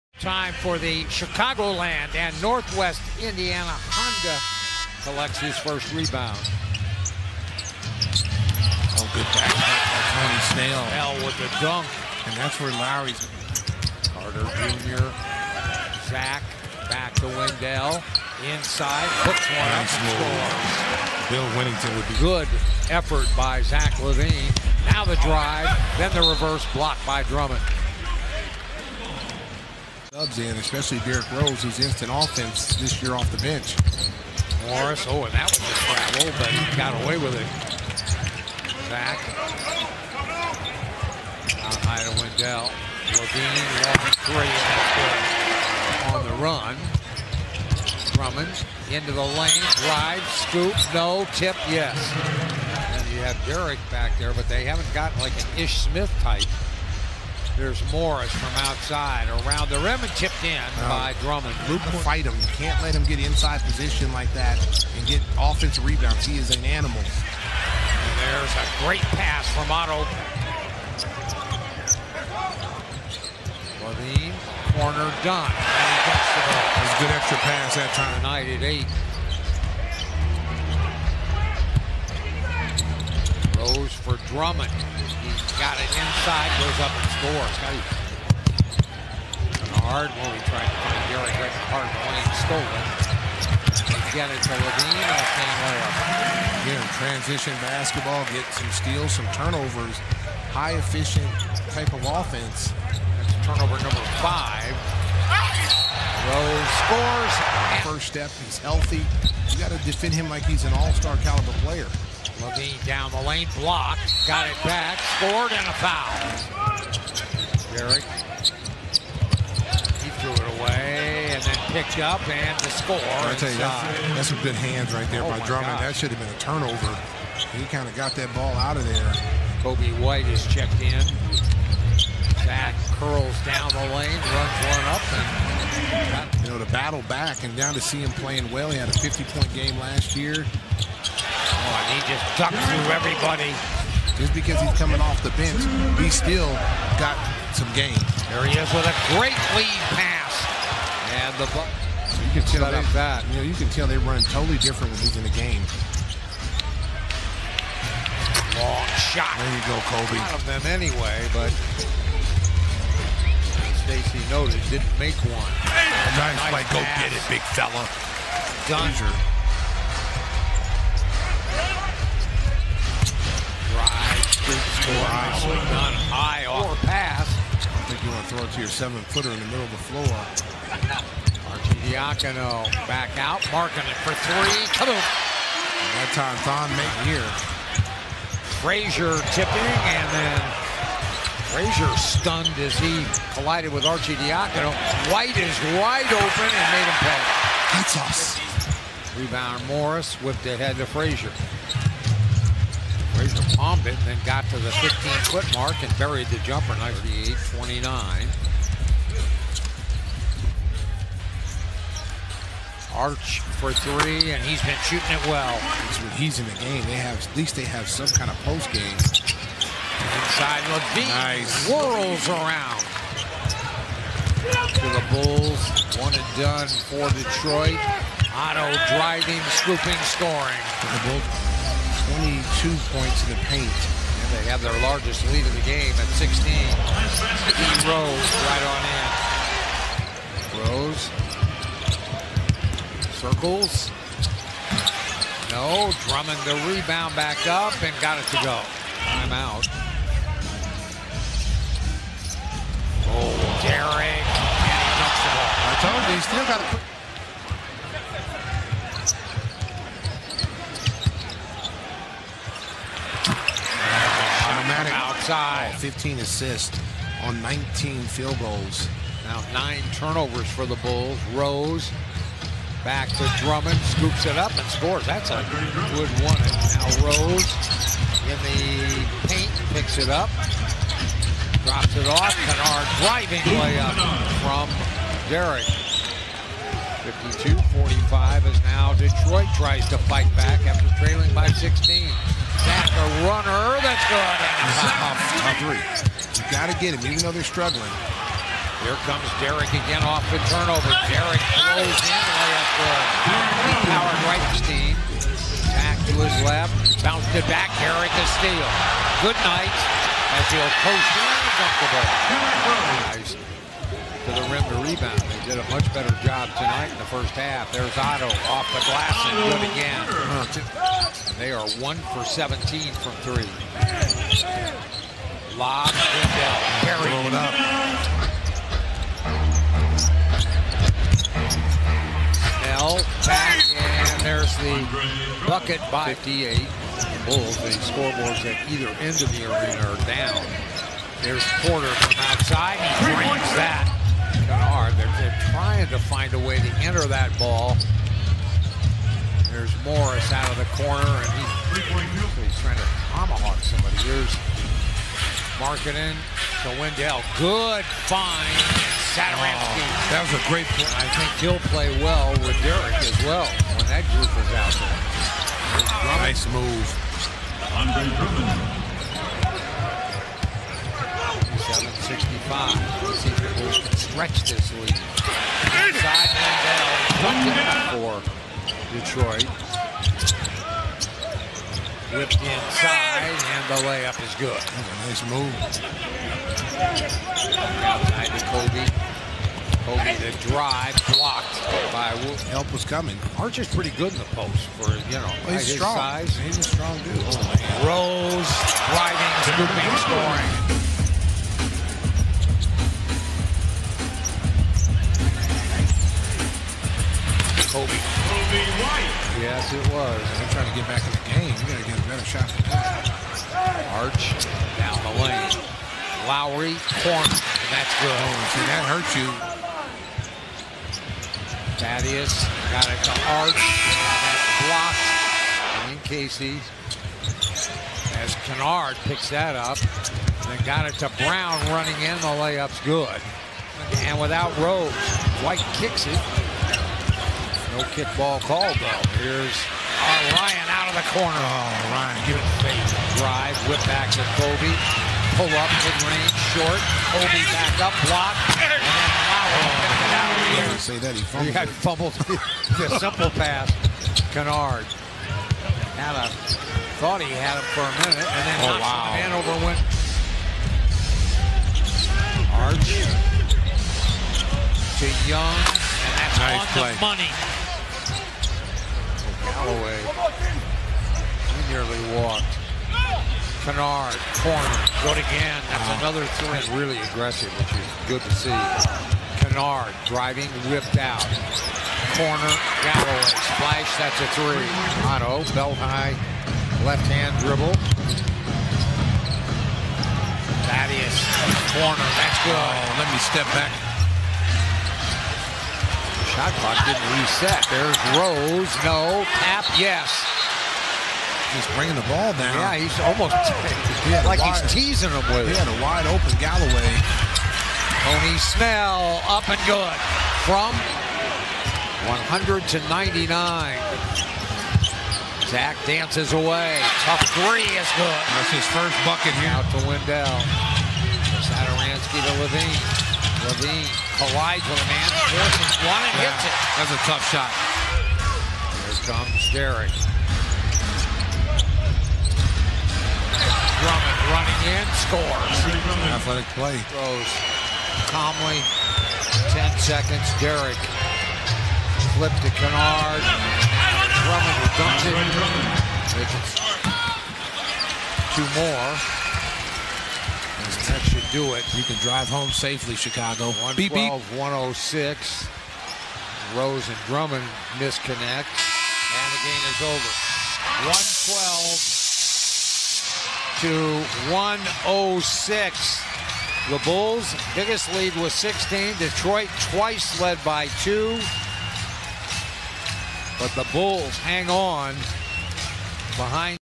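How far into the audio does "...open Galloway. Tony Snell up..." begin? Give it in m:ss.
8:26.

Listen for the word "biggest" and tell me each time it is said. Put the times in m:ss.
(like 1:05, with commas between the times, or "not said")
9:27.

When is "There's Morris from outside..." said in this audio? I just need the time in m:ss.
0:57.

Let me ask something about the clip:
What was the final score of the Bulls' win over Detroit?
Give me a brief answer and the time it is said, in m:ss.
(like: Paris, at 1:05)
112 to 106, at 9:20.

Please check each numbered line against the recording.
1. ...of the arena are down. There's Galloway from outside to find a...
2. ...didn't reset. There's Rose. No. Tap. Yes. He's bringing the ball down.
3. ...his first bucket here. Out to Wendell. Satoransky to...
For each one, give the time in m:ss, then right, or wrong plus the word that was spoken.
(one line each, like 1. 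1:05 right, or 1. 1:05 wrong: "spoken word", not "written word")
1. 5:39 wrong: "Porter", not "Galloway"
2. 8:16 right
3. 8:38 right.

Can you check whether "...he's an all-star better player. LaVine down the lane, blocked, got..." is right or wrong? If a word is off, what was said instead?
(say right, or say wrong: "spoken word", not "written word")
wrong: "caliber", not "better".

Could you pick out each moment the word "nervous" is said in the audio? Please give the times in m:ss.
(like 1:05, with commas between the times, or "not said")
not said.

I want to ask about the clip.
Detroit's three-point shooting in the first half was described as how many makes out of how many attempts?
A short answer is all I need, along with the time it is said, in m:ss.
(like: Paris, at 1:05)
1 for 17, at 5:21.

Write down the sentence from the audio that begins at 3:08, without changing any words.
Frazier tipping, and then Frazier stunned as he collided with Arcidiacono.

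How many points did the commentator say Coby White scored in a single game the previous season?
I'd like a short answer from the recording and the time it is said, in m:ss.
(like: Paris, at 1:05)
50, at 2:18.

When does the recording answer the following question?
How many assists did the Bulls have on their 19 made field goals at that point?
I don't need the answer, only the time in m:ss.
4:25.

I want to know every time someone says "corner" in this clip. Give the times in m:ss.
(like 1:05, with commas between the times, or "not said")
1:14, 5:50, 6:56, 7:21, 7:54, 8:02, 8:11.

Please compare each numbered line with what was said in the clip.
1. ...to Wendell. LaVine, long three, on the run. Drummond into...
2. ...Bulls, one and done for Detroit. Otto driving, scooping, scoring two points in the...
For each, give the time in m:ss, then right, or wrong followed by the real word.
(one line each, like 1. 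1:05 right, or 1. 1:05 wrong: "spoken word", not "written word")
1. 0:42 right
2. 3:45 right.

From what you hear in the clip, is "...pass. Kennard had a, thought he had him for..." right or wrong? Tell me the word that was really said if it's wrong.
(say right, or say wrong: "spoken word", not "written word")
right.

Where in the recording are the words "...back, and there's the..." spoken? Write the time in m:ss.
5:33.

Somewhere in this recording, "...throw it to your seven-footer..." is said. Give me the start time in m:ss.
2:58.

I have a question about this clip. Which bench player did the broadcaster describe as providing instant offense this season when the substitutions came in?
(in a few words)
Derrick Rose.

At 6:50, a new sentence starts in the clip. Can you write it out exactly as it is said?
They're trying to get back in the game.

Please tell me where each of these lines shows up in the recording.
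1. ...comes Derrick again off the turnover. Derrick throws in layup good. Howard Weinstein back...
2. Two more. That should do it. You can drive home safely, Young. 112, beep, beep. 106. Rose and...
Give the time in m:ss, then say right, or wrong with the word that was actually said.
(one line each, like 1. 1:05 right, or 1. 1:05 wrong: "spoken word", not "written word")
1. 4:59 right
2. 9:08 wrong: "Chicago", not "Young".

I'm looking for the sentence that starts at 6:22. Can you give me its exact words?
Whipped inside, and the layup is good.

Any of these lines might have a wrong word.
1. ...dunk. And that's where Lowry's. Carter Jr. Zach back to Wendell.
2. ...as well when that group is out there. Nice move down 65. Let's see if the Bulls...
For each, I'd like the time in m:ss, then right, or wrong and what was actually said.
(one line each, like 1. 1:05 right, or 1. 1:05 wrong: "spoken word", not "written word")
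1. 0:11 right
2. 6:02 right.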